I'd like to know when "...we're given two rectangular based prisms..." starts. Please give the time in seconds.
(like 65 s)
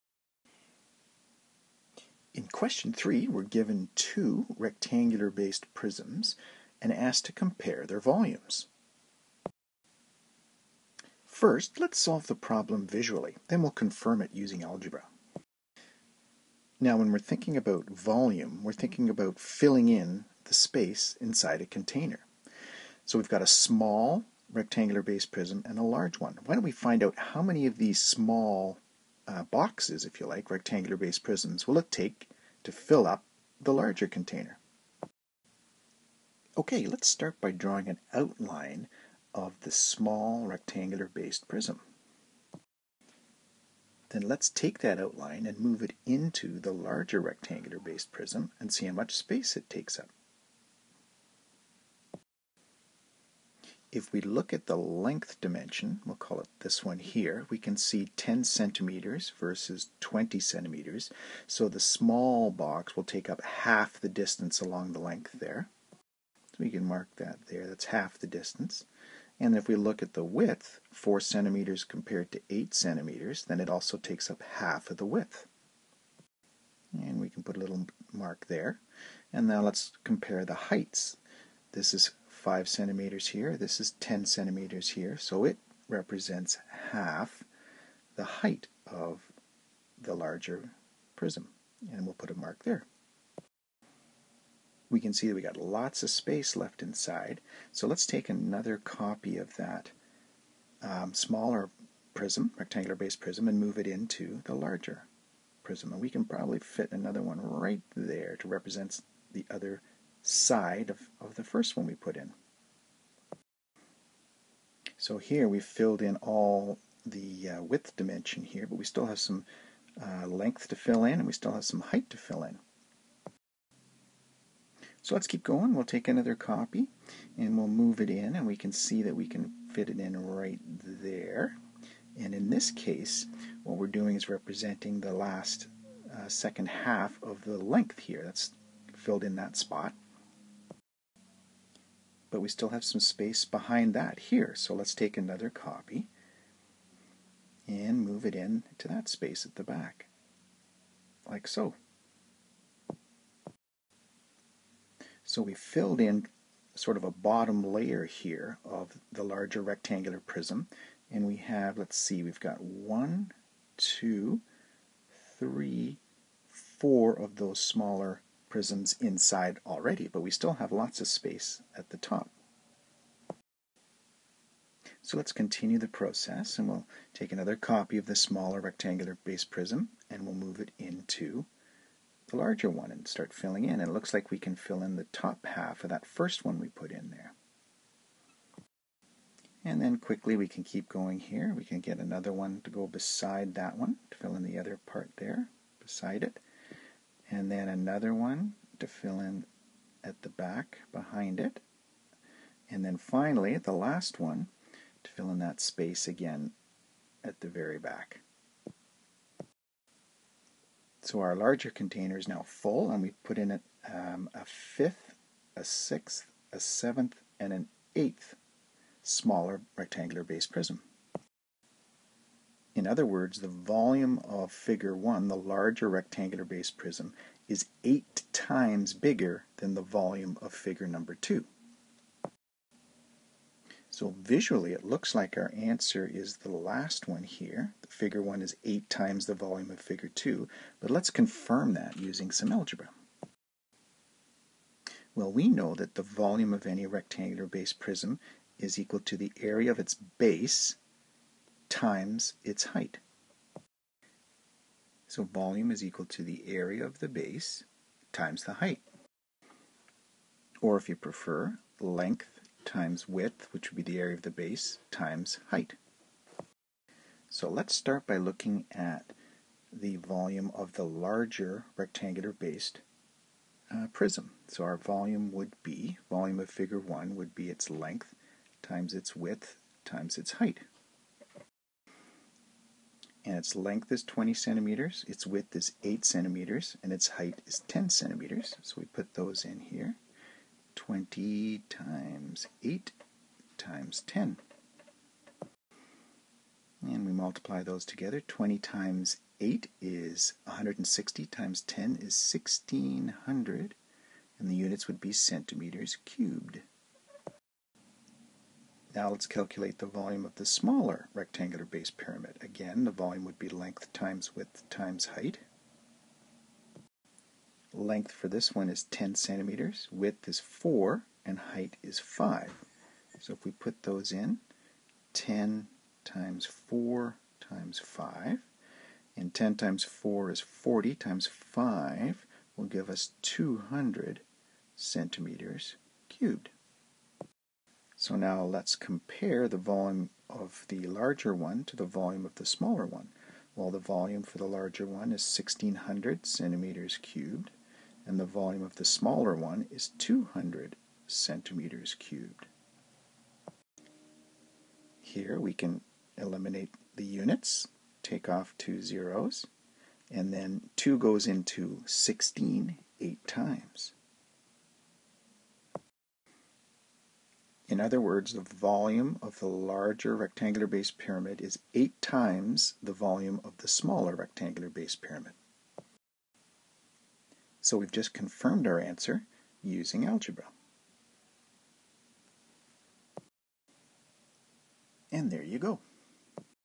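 3 s.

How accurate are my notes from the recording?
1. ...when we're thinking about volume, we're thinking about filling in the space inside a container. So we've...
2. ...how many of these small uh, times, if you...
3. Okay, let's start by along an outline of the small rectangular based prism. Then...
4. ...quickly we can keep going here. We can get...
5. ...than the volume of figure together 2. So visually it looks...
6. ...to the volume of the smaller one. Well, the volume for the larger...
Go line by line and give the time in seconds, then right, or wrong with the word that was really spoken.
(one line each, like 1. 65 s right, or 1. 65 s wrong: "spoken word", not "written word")
1. 16 s right
2. 27 s wrong: "boxes", not "times"
3. 36 s wrong: "drawing", not "along"
4. 189 s right
5. 229 s wrong: "number", not "together"
6. 341 s right.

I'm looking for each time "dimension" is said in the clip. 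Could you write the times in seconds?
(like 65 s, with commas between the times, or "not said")
55 s, 117 s.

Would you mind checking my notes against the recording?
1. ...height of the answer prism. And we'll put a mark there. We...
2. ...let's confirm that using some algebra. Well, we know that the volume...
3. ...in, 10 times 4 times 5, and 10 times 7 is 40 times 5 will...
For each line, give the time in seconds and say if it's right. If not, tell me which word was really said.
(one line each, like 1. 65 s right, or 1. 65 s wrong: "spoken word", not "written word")
1. 88 s wrong: "larger", not "answer"
2. 240 s right
3. 324 s wrong: "4", not "7".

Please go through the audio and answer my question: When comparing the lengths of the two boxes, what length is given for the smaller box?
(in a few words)
10 centimeters.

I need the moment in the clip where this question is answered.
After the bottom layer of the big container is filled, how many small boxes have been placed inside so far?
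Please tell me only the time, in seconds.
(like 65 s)
162 s.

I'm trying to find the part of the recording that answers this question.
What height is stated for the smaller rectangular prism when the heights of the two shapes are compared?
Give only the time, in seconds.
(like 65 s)
81 s.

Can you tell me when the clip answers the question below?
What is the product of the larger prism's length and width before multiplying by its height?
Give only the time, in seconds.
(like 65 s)
298 s.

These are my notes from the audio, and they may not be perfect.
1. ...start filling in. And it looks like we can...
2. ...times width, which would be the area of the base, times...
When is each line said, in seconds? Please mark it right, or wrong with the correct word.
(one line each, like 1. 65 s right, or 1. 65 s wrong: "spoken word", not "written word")
1. 183 s right
2. 262 s right.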